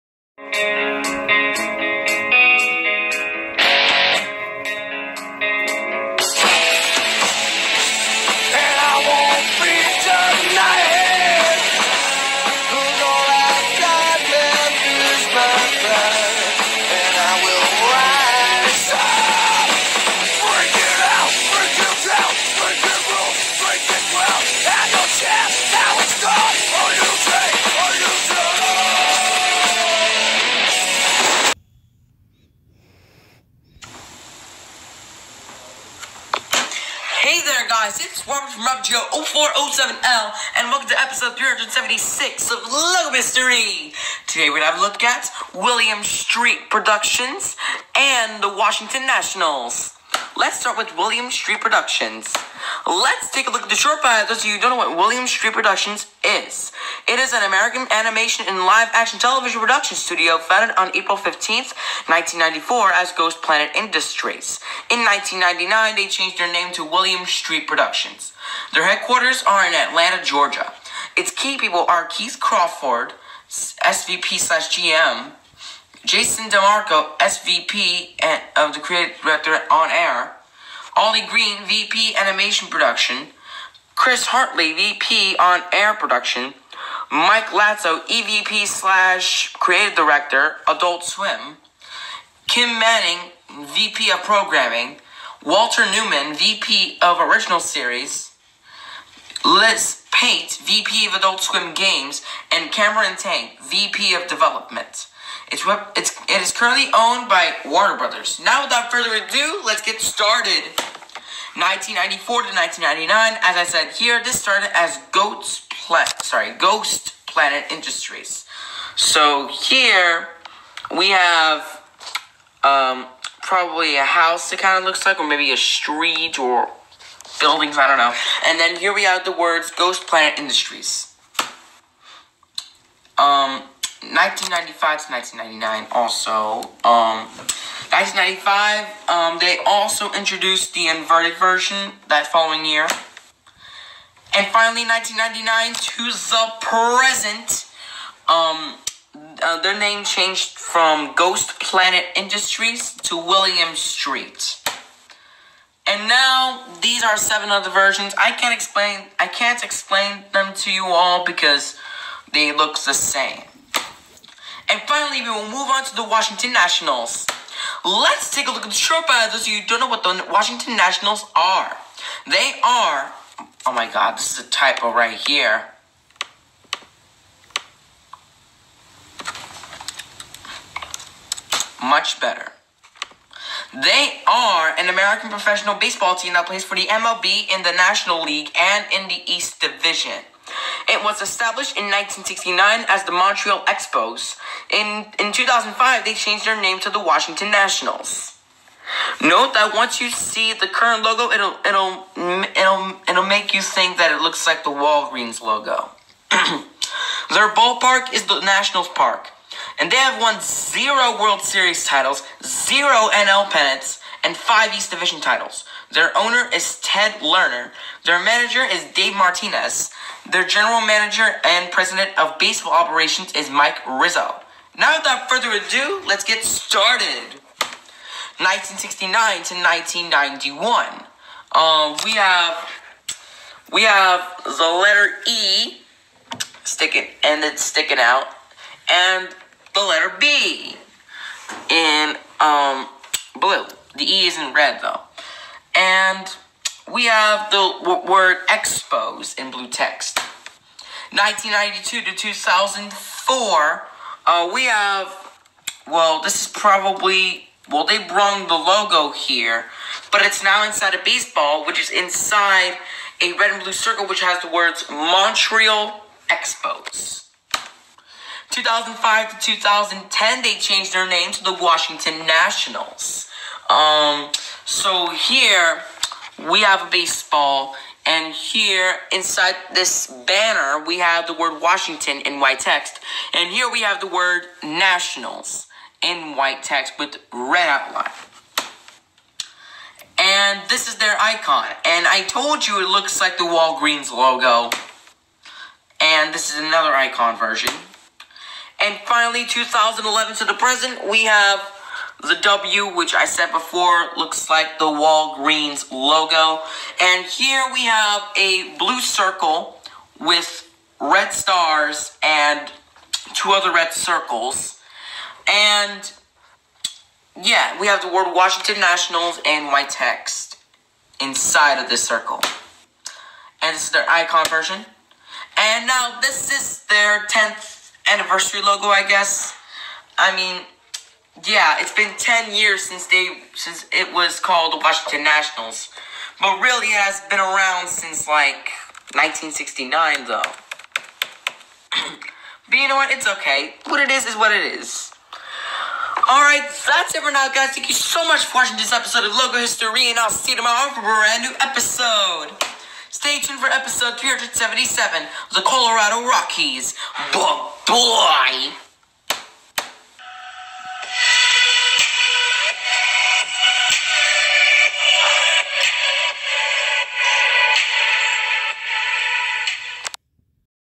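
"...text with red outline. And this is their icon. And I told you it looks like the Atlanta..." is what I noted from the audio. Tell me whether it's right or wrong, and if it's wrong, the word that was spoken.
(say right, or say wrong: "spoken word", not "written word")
wrong: "Walgreens", not "Atlanta".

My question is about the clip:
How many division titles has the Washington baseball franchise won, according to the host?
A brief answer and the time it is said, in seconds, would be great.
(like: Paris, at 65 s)
5, at 214 s.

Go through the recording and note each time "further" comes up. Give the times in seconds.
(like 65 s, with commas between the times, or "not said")
108 s, 225 s.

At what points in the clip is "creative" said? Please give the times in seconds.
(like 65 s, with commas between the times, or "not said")
78 s, 89 s.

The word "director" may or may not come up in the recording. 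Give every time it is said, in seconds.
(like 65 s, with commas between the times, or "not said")
79 s, 89 s.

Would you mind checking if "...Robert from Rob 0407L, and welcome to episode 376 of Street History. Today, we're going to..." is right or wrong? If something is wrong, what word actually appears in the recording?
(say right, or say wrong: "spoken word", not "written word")
wrong: "Logo", not "Street".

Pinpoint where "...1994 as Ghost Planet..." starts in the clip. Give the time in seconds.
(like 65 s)
62 s.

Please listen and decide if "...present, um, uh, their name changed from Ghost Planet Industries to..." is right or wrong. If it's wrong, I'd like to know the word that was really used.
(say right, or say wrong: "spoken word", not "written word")
right.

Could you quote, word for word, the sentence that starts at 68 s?
Their headquarters are in Atlanta, Georgia.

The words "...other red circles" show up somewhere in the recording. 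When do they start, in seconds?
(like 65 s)
313 s.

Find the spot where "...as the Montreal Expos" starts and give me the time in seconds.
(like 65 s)
192 s.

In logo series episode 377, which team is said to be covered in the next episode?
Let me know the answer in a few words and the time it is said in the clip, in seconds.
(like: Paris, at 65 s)
Colorado Rockies, at 355 s.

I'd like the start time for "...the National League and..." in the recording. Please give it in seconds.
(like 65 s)
187 s.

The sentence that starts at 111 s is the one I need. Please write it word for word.
1994 to 1999, as I said here, this started as Goat's Planet, sorry, Ghost Planet Industries.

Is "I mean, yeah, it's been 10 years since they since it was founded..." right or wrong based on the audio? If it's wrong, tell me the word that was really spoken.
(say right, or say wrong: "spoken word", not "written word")
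wrong: "called", not "founded".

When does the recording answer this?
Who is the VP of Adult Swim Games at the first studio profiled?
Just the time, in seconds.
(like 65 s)
99 s.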